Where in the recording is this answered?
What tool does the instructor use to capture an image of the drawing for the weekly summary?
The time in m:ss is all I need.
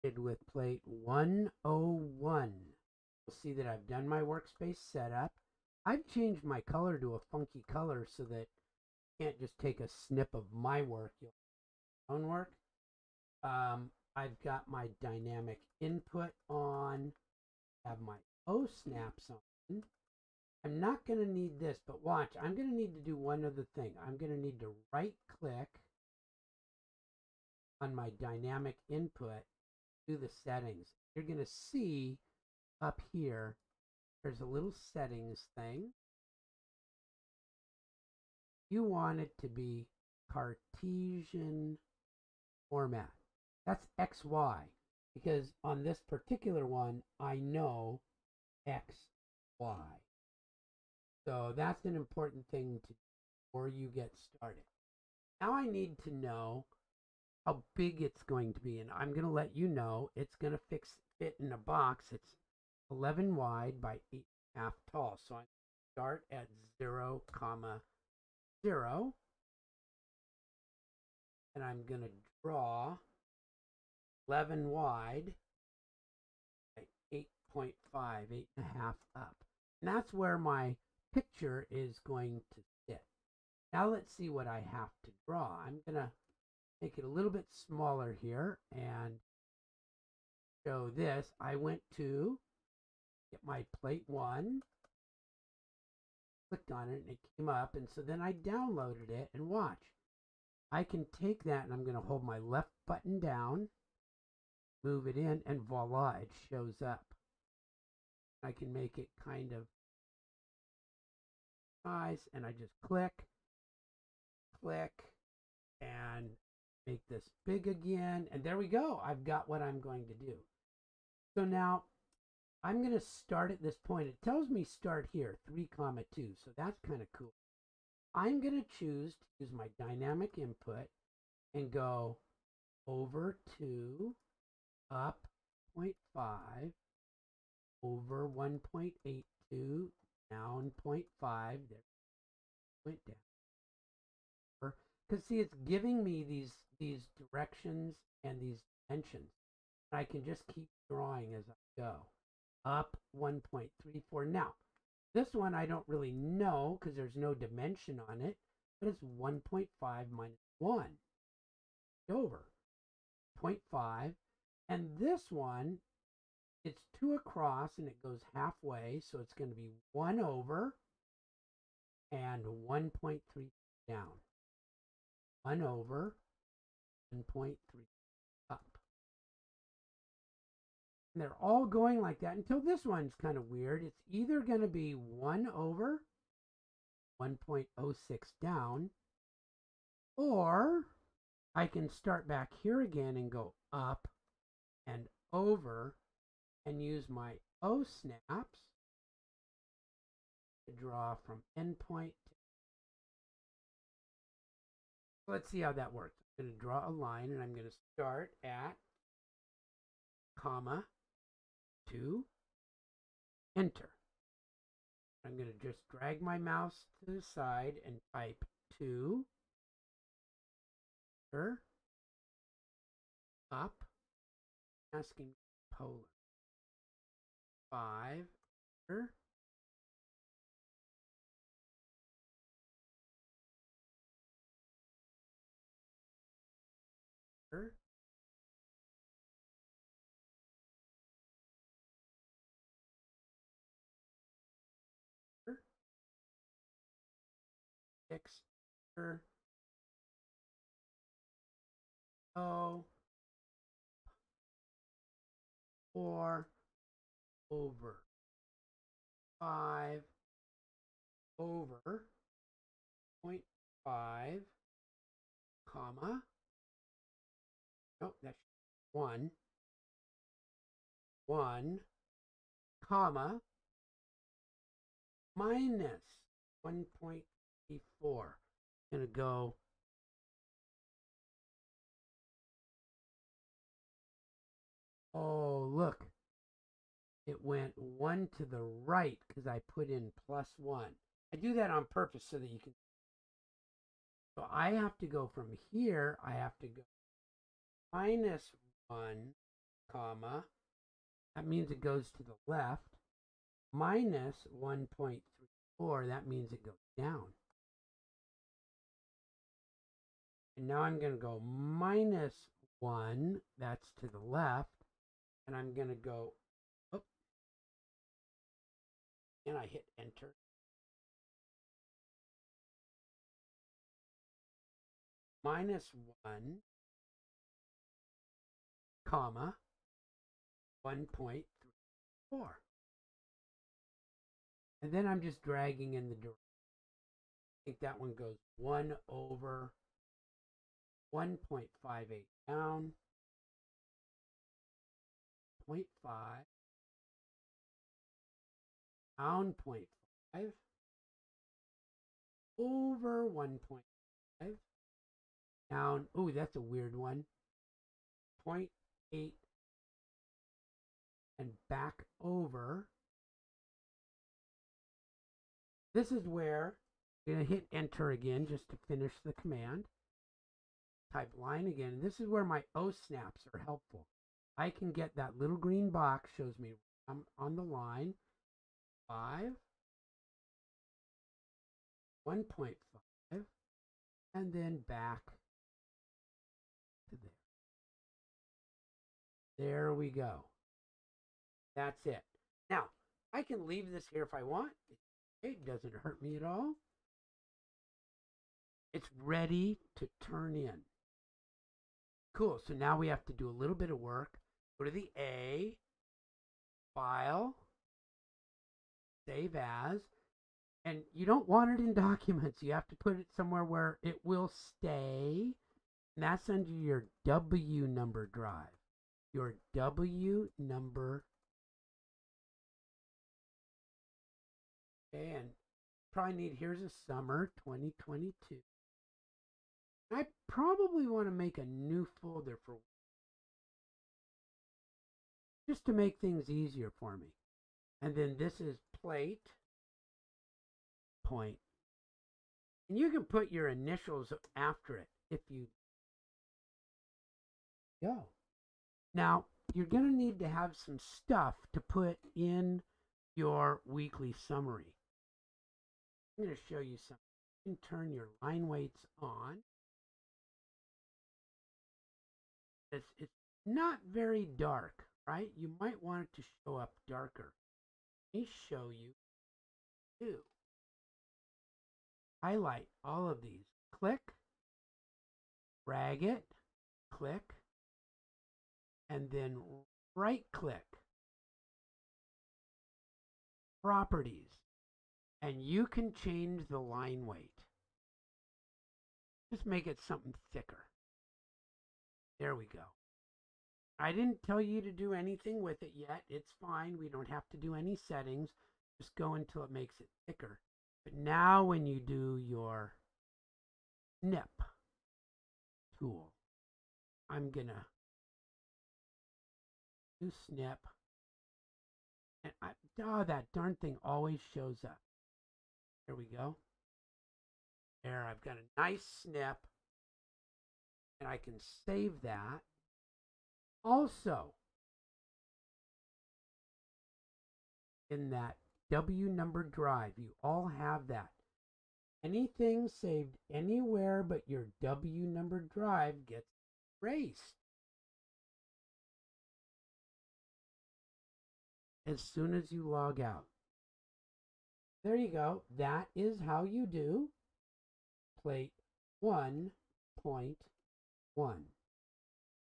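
8:24.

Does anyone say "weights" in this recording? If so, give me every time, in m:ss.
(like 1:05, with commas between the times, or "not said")
7:38, 8:07.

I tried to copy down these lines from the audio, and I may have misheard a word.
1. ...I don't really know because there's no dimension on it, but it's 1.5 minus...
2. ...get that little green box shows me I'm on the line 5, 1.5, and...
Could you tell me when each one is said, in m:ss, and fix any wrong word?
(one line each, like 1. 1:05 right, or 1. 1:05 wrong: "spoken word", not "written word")
1. 2:35 right
2. 6:14 right.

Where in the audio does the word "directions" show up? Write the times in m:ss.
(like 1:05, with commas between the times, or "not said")
2:27, 5:36.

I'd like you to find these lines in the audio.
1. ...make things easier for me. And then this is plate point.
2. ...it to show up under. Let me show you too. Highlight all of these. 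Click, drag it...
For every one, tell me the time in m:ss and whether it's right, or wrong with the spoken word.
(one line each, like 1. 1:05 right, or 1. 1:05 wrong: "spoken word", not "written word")
1. 7:15 right
2. 7:46 wrong: "darker", not "under".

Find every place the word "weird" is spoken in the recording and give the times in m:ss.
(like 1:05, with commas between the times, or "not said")
3:03, 5:56.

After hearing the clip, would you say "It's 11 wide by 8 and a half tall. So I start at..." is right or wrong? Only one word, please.
right.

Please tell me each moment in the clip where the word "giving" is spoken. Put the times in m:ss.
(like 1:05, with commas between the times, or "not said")
2:25.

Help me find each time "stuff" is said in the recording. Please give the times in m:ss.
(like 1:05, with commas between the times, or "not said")
7:30.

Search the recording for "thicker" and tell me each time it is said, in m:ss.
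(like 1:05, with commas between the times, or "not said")
8:10, 8:20.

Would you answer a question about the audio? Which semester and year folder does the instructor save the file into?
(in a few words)
summer 2022.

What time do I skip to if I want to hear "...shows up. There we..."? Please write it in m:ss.
8:34.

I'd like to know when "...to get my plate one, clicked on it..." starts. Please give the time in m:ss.
1:31.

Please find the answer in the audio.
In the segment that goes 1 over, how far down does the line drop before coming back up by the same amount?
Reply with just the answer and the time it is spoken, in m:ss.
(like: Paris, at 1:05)
1.3, at 2:52.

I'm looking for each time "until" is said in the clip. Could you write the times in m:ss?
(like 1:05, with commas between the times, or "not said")
3:02, 8:19.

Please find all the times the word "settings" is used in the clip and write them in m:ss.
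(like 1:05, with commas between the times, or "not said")
0:30, 0:34, 8:17.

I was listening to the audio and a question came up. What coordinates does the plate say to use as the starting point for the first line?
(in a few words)
3,2.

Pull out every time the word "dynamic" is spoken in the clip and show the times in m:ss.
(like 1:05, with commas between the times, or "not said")
0:15, 0:28, 2:09.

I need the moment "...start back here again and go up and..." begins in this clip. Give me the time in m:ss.
3:11.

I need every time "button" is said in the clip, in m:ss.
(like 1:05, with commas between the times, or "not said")
1:42.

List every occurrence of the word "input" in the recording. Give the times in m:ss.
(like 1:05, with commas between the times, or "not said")
0:15, 0:28, 2:10.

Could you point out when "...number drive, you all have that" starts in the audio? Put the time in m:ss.
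8:49.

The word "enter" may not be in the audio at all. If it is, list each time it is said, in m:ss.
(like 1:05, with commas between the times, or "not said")
3:33, 3:41, 3:48, 5:19, 6:07.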